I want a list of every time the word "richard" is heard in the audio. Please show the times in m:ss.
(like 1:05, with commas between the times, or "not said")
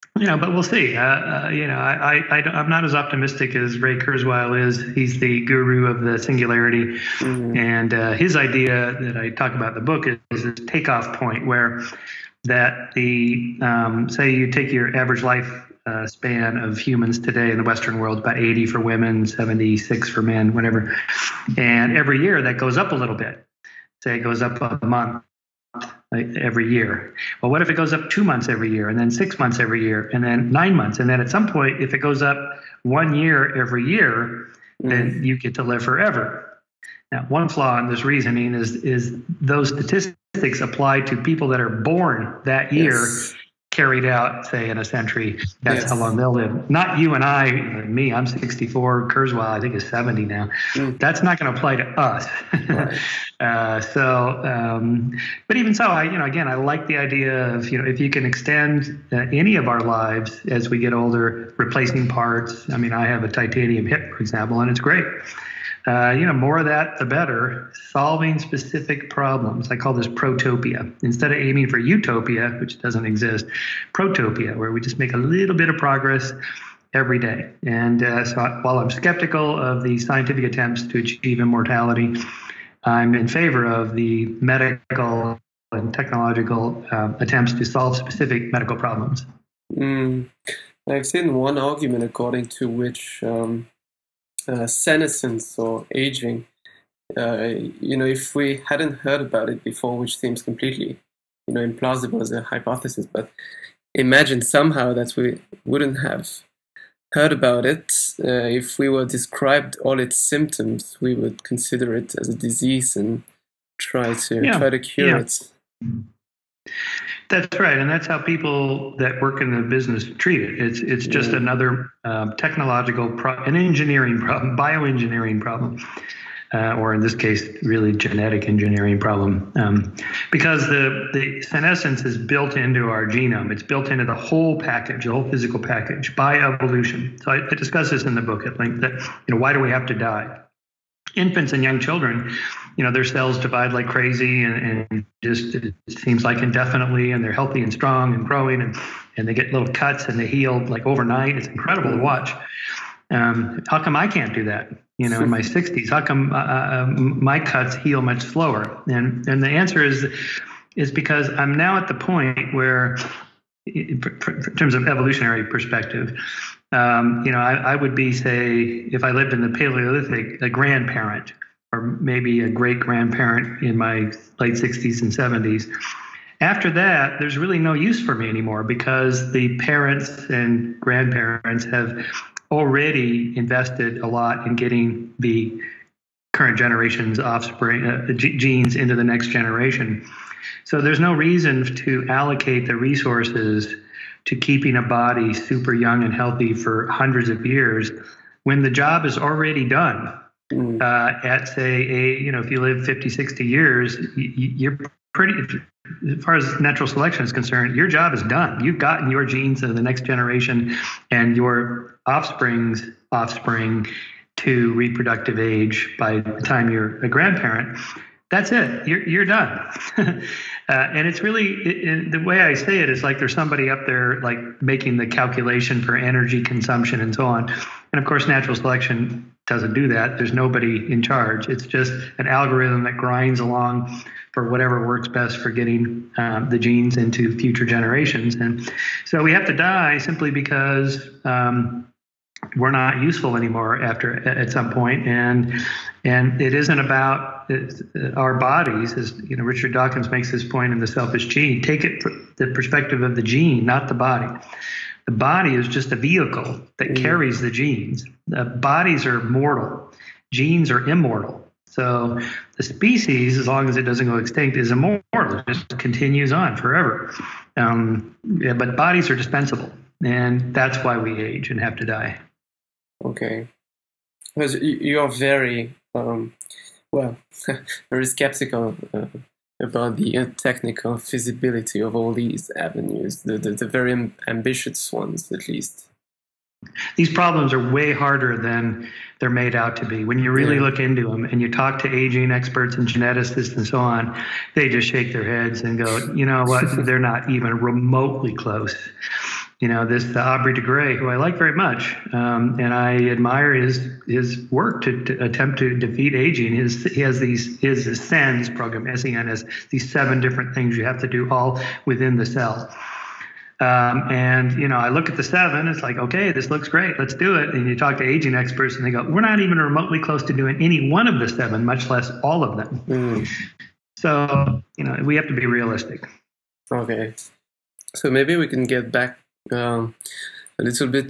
4:09.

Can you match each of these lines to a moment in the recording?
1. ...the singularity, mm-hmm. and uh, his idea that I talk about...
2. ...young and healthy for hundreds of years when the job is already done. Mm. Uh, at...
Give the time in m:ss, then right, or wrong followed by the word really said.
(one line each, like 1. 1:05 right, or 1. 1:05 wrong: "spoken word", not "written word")
1. 0:06 right
2. 3:15 right.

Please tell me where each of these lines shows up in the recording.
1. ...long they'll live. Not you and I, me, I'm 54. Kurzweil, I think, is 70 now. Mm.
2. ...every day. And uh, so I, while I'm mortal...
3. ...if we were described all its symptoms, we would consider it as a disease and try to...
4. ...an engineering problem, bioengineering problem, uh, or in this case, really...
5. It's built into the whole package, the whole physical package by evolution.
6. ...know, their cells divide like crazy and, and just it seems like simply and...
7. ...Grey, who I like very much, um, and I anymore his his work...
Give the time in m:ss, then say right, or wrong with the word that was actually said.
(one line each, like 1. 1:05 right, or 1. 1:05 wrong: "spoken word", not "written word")
1. 0:45 wrong: "64", not "54"
2. 1:16 wrong: "skeptical", not "mortal"
3. 1:48 right
4. 2:03 right
5. 2:13 right
6. 2:22 wrong: "indefinitely", not "simply"
7. 5:00 wrong: "admire", not "anymore".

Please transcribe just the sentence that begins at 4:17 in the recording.
carries the genes the bodies are mortal genes are immortal so the species, as long as it doesn't go extinct, is immortal.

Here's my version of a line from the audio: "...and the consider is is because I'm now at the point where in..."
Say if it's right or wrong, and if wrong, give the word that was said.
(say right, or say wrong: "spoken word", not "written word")
wrong: "answer", not "consider".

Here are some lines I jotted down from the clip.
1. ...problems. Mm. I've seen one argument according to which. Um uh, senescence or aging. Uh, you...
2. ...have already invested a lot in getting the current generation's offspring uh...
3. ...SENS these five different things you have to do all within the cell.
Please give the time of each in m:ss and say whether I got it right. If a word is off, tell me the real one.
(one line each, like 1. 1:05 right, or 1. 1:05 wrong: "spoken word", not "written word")
1. 1:28 right
2. 3:01 right
3. 5:08 wrong: "seven", not "five".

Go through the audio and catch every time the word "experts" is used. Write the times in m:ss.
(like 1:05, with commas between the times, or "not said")
4:52, 5:18.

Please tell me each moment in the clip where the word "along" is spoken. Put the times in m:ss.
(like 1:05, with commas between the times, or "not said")
3:53.